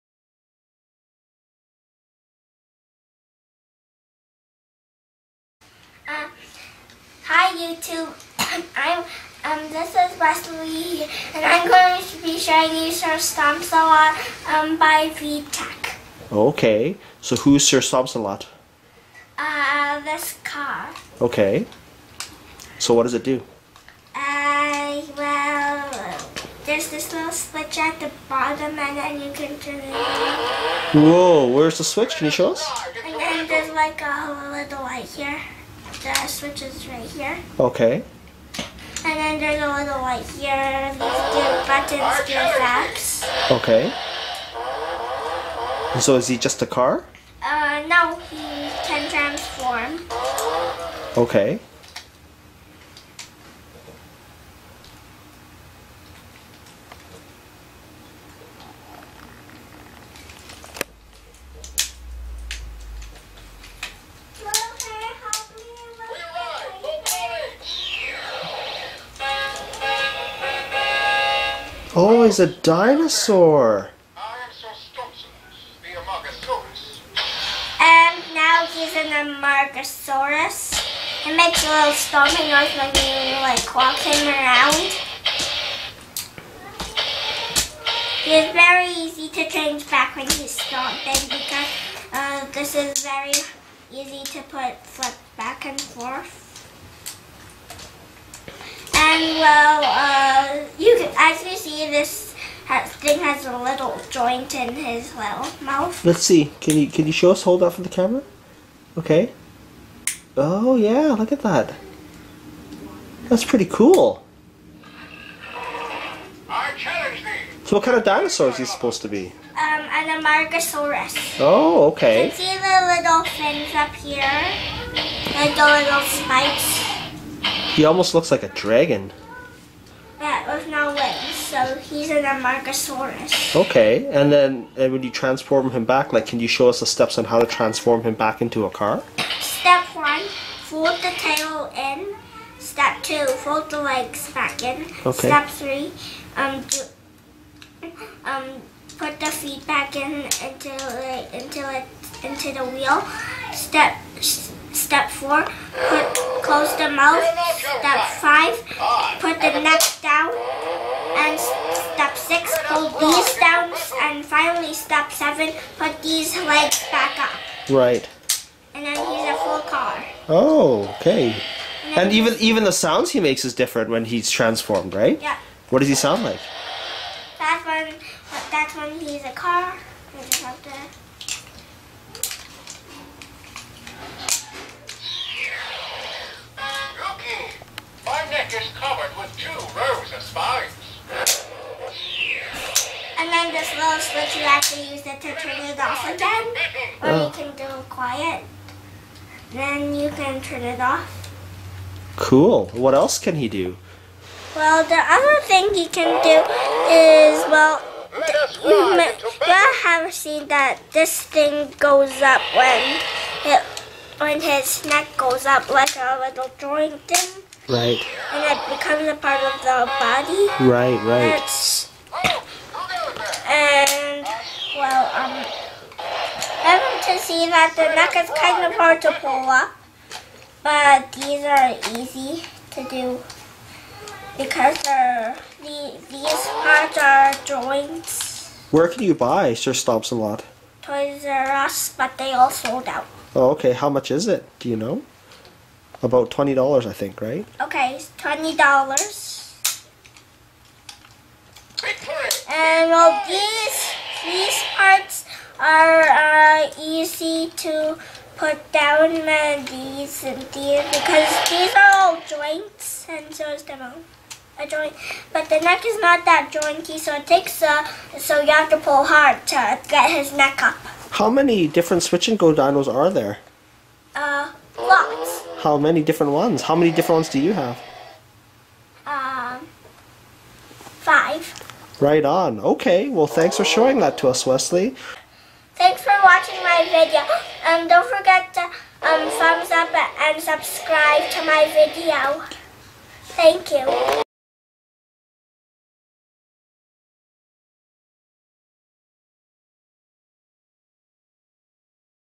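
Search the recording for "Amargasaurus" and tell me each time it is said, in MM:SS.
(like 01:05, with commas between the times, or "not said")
01:19, 02:00, 02:12.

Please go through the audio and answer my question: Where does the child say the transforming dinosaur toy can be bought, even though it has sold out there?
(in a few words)
Toys R Us.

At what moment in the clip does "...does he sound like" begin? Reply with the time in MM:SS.
02:55.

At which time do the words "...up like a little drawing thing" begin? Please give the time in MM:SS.
03:35.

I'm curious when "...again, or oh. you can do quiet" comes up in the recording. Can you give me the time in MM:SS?
03:16.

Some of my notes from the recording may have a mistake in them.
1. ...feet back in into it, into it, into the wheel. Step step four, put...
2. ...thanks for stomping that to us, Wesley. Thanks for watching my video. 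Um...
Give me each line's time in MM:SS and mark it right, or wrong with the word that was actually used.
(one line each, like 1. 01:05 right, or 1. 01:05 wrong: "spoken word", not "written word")
1. 02:29 right
2. 04:43 wrong: "showing", not "stomping".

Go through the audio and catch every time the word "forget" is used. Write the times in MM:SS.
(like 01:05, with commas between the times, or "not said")
04:48.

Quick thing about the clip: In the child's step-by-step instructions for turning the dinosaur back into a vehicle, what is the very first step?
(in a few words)
Fold the tail in.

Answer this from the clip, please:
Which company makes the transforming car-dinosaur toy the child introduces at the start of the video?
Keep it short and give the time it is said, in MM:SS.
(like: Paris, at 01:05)
VTech, at 00:15.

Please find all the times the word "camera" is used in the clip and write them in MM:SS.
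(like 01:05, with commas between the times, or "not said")
01:47.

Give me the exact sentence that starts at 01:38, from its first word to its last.
And well, uh, as you see, this has, thing has a little joint in his little mouth.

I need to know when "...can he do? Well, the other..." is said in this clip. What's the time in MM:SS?
03:23.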